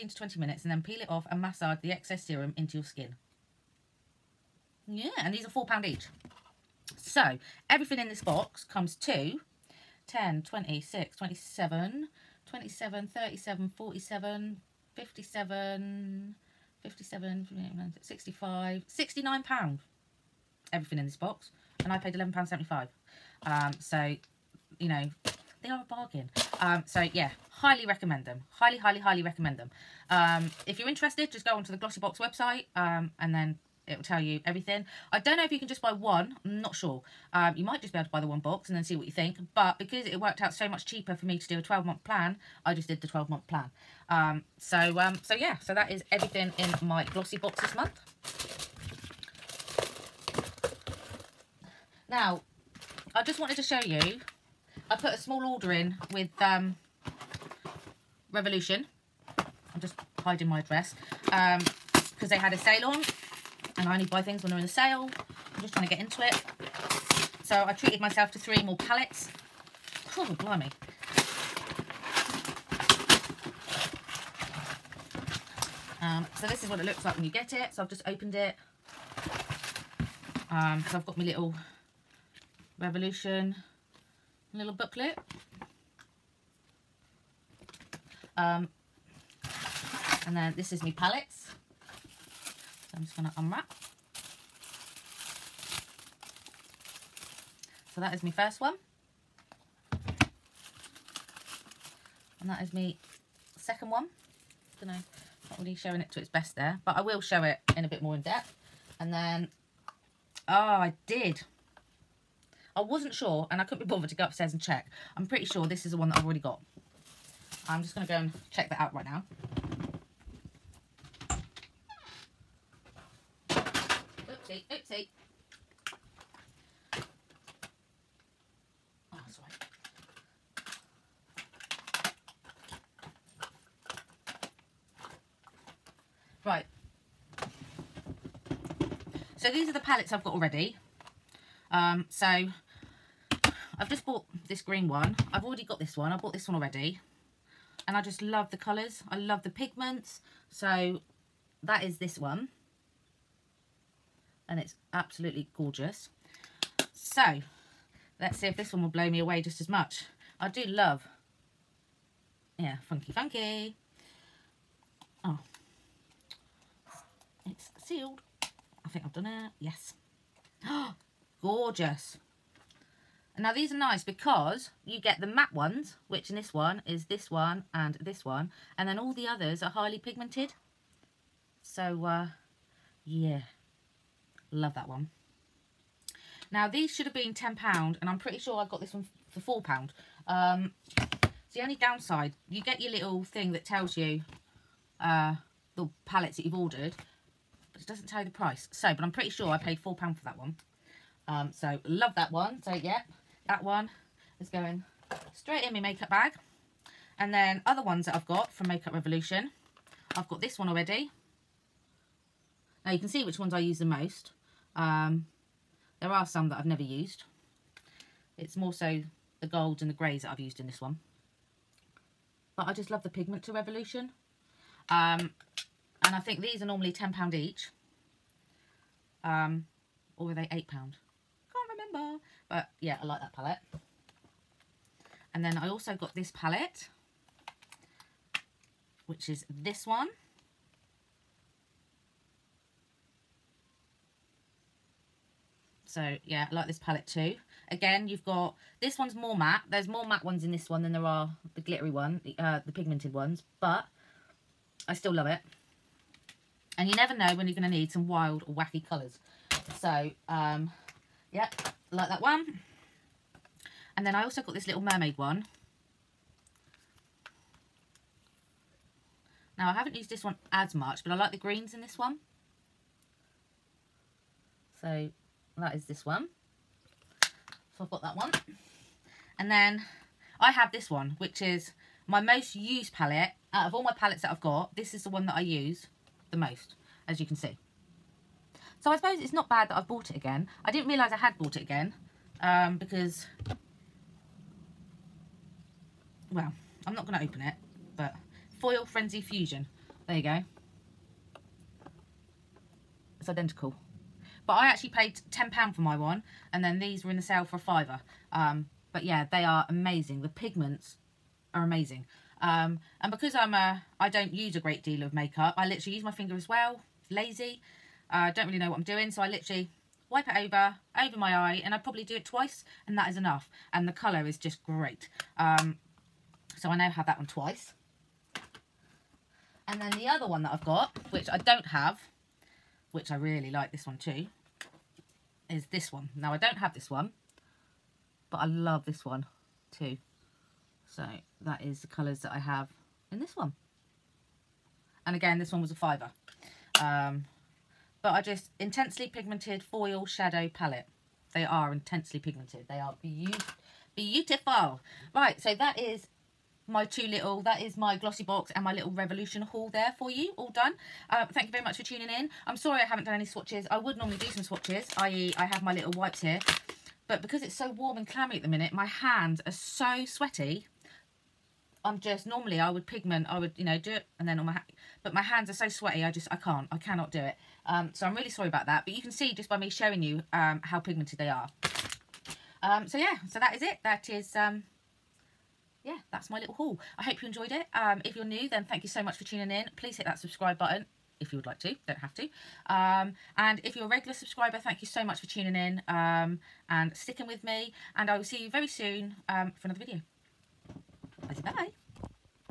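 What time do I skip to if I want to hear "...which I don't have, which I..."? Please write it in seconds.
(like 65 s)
331 s.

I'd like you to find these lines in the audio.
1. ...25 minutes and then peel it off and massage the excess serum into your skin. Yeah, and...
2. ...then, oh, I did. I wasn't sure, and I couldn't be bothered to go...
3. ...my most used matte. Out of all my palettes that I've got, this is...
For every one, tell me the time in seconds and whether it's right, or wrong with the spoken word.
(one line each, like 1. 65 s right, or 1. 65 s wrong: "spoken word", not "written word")
1. 0 s wrong: "20", not "25"
2. 109 s right
3. 282 s wrong: "palette", not "matte".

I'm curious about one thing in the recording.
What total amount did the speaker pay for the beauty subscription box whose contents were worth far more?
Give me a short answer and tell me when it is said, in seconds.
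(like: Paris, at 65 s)
£11.75, at 22 s.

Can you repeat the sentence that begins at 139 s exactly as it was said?
So these are the palettes I've got already.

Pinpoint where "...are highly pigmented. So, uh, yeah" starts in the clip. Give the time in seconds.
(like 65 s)
179 s.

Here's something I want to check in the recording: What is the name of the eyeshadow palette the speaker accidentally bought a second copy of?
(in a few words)
Foil Frenzy Fusion.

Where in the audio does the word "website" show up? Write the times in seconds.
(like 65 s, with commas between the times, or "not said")
32 s.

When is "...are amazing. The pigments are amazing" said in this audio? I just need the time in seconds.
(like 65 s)
309 s.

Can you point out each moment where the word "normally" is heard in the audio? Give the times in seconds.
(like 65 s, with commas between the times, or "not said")
226 s, 363 s, 372 s.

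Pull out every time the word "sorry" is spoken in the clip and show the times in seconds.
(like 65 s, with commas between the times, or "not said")
362 s, 378 s.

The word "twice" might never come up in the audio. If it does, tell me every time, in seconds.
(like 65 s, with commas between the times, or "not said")
322 s, 327 s.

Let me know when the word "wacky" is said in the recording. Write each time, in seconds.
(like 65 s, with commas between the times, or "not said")
258 s.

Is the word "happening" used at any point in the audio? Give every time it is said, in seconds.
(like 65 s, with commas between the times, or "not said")
not said.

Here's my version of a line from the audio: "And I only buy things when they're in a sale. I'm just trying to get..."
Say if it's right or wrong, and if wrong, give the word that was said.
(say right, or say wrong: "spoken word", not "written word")
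right.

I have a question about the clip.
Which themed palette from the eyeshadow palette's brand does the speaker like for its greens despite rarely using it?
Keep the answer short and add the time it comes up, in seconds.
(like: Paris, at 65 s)
mermaid, at 264 s.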